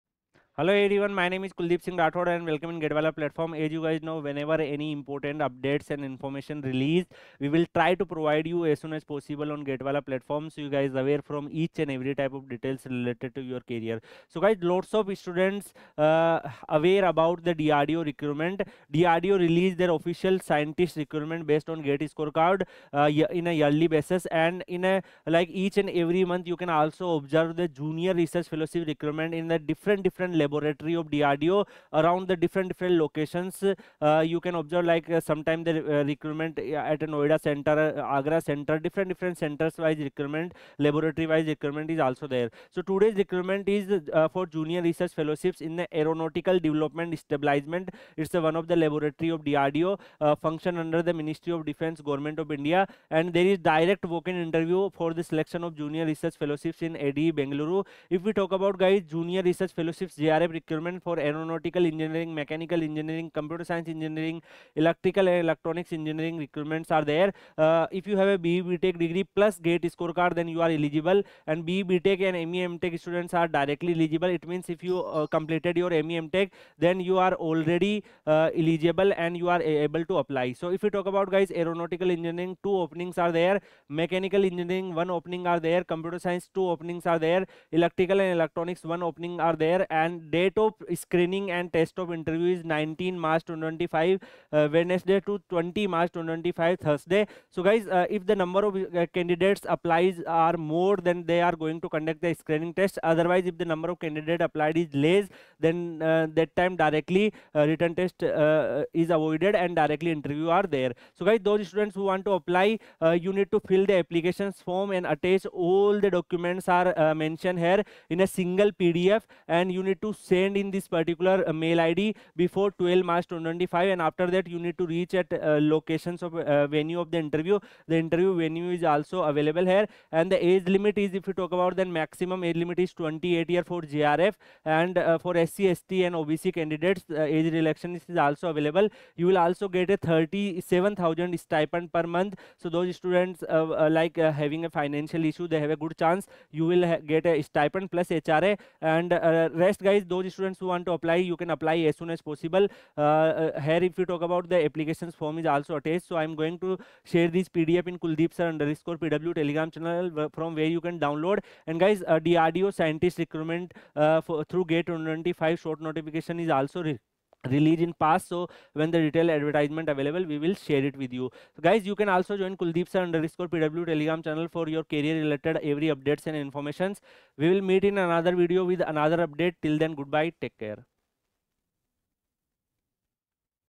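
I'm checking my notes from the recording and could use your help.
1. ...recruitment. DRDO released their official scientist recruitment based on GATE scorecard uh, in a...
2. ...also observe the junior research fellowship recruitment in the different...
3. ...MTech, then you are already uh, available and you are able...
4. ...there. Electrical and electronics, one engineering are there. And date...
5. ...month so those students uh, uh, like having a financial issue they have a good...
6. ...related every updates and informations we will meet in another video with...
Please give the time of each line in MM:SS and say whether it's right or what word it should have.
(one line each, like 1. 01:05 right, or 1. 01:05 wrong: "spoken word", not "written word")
1. 00:18 right
2. 00:26 right
3. 01:16 wrong: "eligible", not "available"
4. 01:27 wrong: "opening", not "engineering"
5. 02:22 right
6. 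02:55 right.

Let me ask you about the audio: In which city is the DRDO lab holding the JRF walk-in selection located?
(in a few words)
Bengaluru.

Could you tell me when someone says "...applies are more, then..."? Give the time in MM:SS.
01:39.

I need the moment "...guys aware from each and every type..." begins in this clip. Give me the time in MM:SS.
00:10.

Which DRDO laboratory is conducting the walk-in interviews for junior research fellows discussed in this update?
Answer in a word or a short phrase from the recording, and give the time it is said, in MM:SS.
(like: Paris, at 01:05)
Aeronautical Development Establishment, at 00:46.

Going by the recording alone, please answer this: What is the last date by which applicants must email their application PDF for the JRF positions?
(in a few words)
12 March 2025.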